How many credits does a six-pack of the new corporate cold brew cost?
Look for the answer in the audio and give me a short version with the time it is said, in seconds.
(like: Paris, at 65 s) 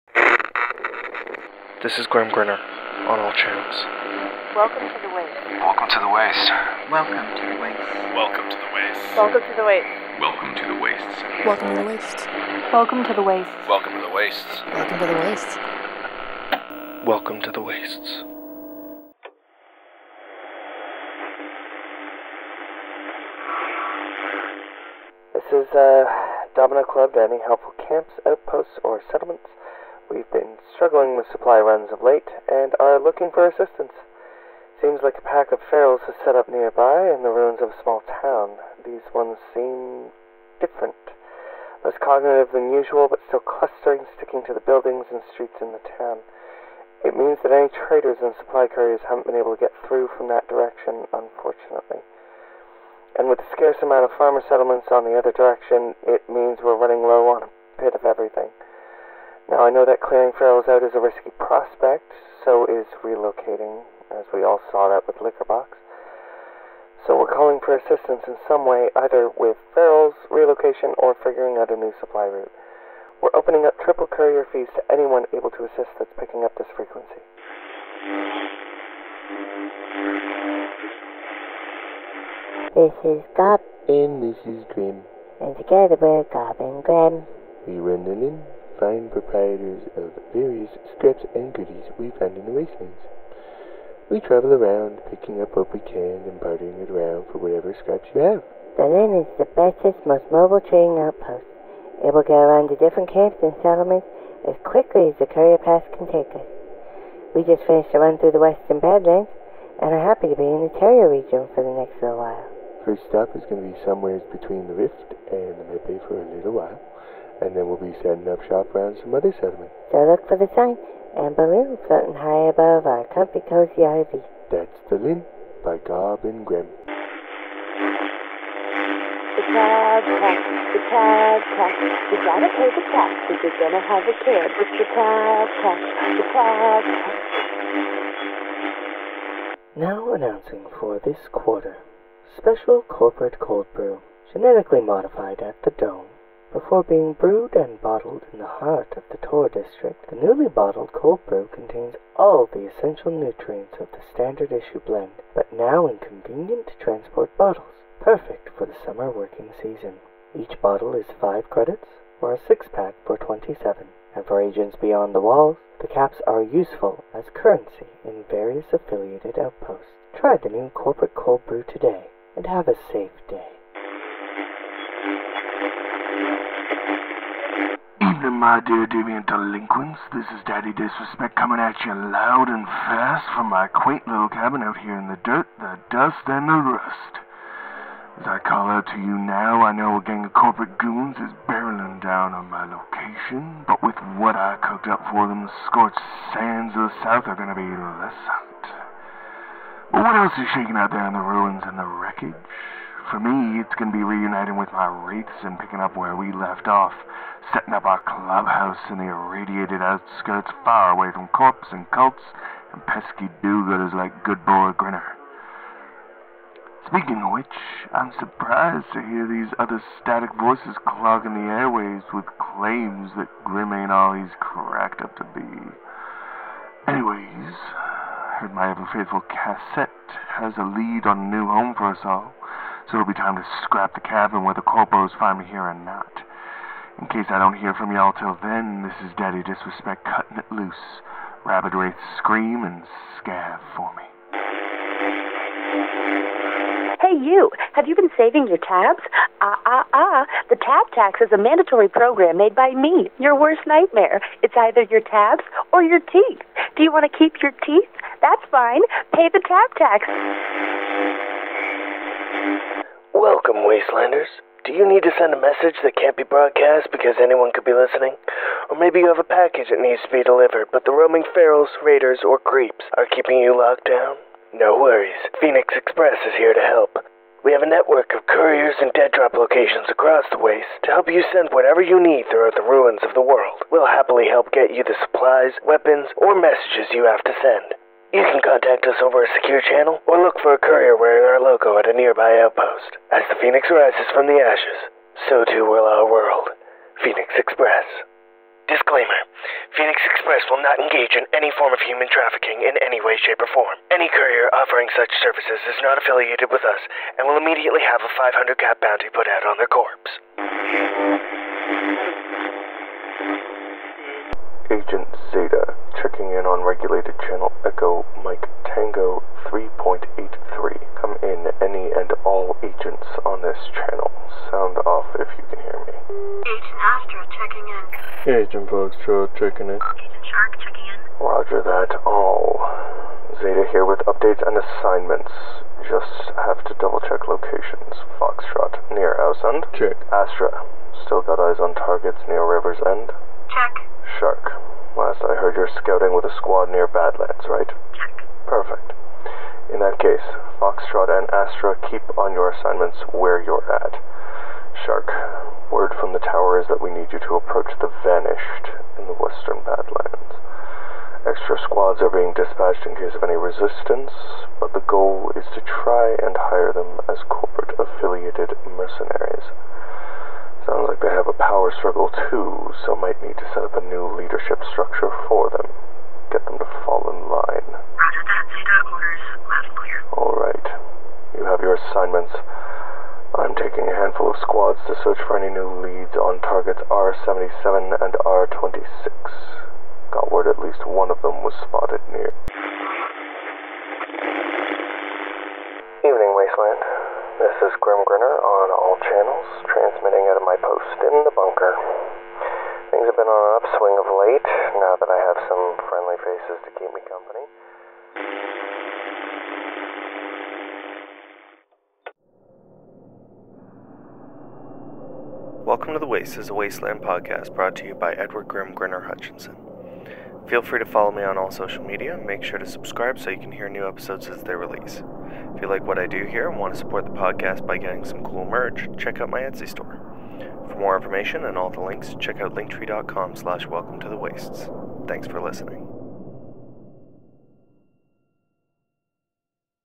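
27, at 163 s.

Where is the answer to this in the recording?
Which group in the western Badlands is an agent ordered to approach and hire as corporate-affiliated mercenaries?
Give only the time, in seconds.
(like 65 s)
357 s.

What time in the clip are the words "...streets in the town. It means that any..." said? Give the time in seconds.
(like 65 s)
45 s.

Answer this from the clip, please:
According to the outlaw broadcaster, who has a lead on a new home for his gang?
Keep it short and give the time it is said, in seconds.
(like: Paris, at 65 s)
Cassette, at 229 s.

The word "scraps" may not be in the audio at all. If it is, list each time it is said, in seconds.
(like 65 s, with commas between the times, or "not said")
90 s, 97 s, 233 s.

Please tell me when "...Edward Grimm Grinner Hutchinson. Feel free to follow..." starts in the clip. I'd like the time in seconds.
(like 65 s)
418 s.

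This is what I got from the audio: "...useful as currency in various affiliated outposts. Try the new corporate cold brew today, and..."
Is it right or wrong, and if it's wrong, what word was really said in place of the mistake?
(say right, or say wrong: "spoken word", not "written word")
right.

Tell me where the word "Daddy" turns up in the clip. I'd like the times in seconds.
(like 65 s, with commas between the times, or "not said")
180 s, 239 s.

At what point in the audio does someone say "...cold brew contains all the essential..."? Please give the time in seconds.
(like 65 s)
150 s.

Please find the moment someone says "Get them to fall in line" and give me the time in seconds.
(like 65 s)
376 s.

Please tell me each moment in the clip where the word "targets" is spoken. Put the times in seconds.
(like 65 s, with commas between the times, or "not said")
341 s, 386 s.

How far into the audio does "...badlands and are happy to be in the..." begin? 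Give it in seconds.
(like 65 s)
108 s.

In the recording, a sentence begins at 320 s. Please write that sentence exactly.
Come in any and all agents on this channel.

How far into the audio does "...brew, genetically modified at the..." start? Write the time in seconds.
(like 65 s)
143 s.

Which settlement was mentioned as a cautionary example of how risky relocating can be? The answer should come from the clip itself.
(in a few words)
Liquorbox.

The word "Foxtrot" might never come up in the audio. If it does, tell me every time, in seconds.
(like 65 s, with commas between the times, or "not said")
328 s, 338 s, 350 s.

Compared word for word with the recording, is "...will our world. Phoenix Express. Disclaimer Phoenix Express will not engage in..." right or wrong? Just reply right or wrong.
right.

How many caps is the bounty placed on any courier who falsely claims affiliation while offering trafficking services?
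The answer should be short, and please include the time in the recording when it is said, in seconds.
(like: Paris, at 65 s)
500, at 308 s.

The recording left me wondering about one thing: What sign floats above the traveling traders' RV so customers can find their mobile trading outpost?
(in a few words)
Amber Moon.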